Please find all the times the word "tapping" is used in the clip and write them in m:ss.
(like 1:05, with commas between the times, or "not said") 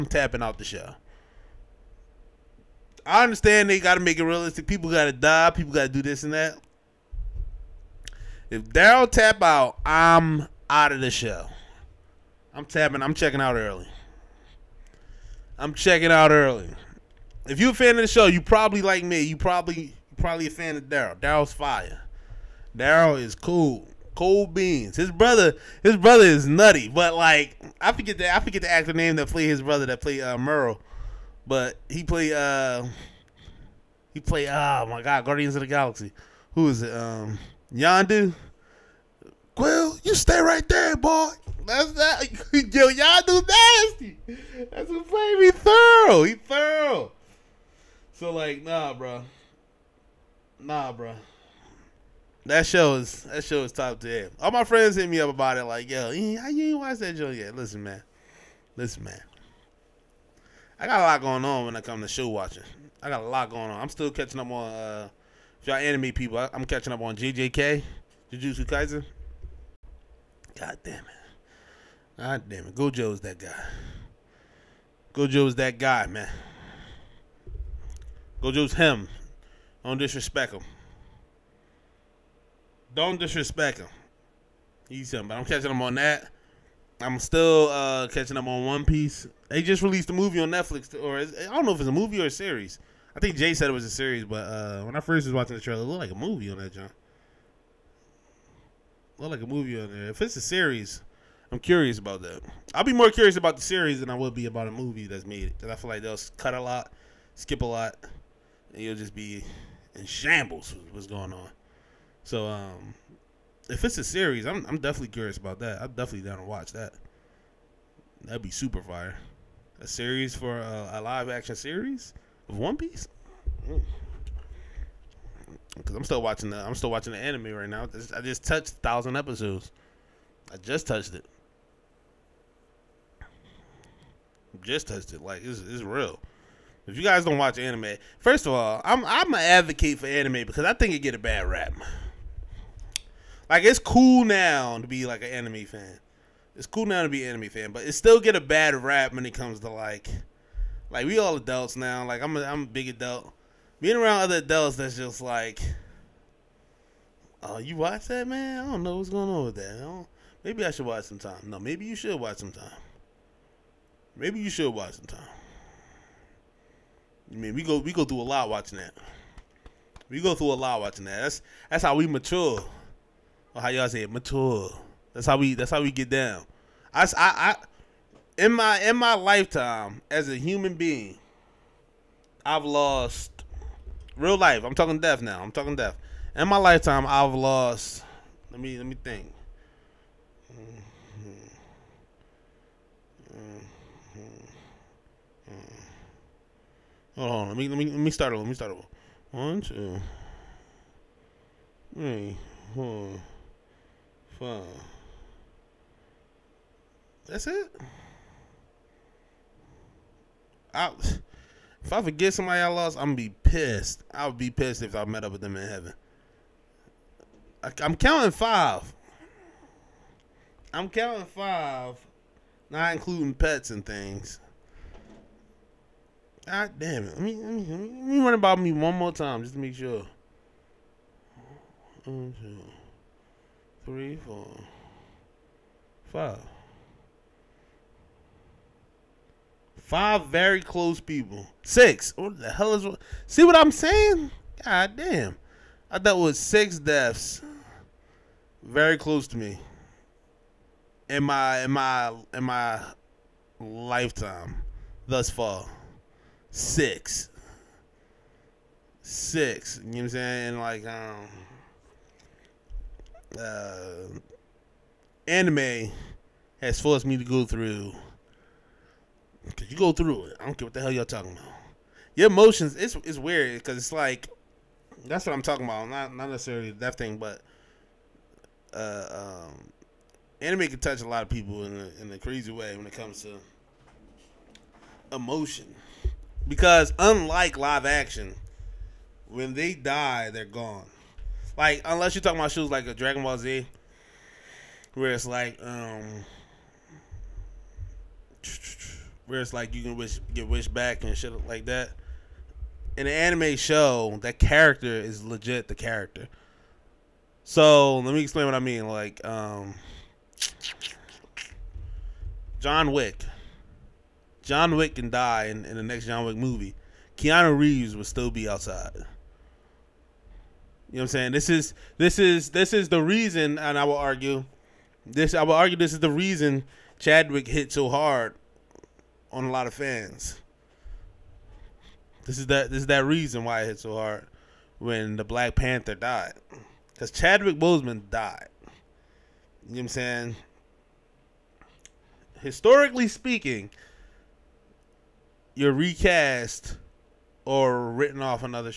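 0:00, 0:12.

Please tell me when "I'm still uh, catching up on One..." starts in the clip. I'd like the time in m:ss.
1:27.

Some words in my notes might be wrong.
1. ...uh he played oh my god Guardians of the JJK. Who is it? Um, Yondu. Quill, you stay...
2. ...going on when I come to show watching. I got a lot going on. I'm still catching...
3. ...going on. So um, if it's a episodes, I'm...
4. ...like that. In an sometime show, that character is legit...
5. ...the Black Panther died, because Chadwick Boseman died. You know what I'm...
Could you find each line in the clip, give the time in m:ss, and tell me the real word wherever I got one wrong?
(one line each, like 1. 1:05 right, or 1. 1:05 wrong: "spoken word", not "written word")
1. 0:32 wrong: "Galaxy", not "JJK"
2. 1:01 right
3. 1:51 wrong: "series", not "episodes"
4. 5:01 wrong: "anime", not "sometime"
5. 5:35 right.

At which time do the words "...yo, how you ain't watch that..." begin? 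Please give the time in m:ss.
0:55.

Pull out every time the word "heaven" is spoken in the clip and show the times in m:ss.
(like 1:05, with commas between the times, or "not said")
3:35.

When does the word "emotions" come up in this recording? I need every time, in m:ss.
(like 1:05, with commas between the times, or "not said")
4:32, 4:45.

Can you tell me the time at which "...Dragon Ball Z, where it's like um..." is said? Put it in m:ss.
4:52.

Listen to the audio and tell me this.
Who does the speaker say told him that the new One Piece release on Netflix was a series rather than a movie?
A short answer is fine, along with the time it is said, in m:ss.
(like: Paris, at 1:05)
Jay, at 1:33.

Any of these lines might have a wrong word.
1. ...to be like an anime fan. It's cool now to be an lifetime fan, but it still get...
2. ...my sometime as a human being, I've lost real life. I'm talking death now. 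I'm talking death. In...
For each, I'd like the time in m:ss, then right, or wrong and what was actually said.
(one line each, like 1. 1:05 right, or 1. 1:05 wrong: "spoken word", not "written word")
1. 2:24 wrong: "anime", not "lifetime"
2. 2:58 wrong: "lifetime", not "sometime".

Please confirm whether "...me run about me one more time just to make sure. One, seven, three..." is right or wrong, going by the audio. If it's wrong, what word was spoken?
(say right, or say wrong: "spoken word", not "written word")
wrong: "two", not "seven".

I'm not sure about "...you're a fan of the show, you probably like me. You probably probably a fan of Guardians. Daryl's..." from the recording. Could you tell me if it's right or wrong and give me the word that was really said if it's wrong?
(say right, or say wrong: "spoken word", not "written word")
wrong: "Daryl", not "Guardians".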